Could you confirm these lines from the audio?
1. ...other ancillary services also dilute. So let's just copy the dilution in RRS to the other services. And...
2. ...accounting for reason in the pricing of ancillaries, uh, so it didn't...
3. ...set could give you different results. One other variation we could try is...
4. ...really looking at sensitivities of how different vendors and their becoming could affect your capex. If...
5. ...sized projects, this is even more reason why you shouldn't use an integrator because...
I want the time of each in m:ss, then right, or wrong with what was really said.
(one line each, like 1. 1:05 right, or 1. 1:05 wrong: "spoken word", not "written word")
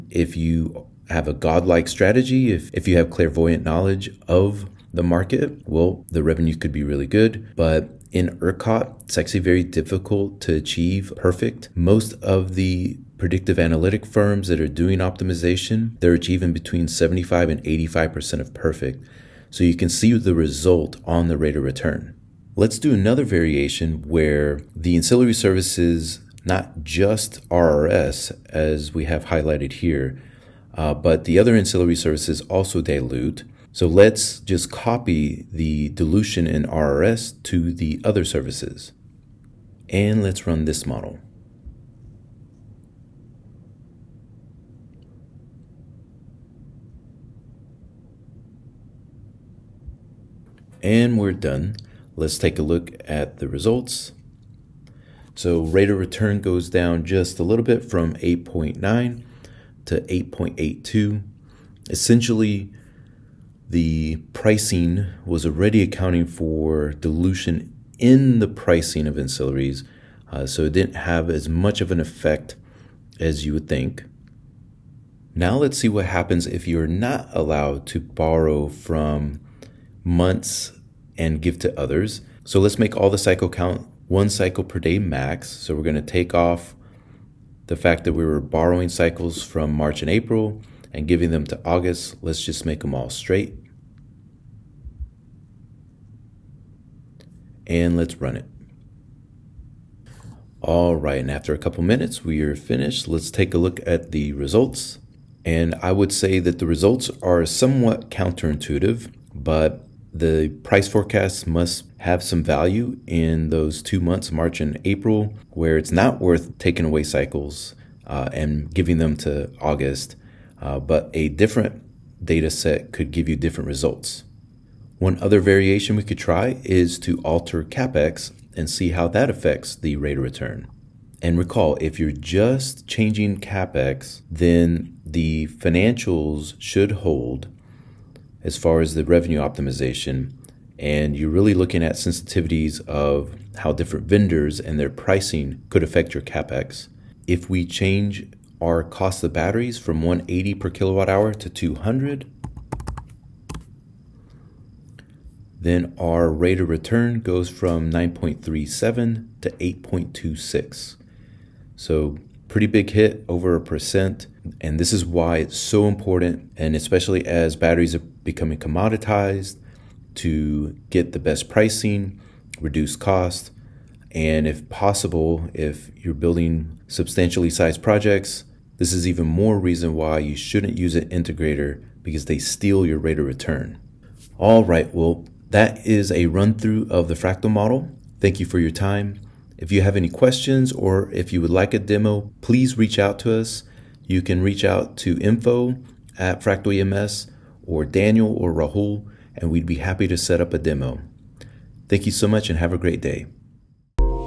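1. 0:31 right
2. 1:05 wrong: "dilution", not "reason"
3. 2:02 right
4. 2:21 wrong: "pricing", not "becoming"
5. 2:57 right.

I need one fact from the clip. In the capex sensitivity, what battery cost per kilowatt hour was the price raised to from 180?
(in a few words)
200.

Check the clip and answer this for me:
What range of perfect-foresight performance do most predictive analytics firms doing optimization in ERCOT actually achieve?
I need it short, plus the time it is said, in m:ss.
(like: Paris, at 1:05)
75 to 85%, at 0:16.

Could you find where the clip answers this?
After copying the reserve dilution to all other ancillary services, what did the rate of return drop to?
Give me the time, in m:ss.
1:00.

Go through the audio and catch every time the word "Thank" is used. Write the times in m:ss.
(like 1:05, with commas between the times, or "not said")
3:08, 3:21.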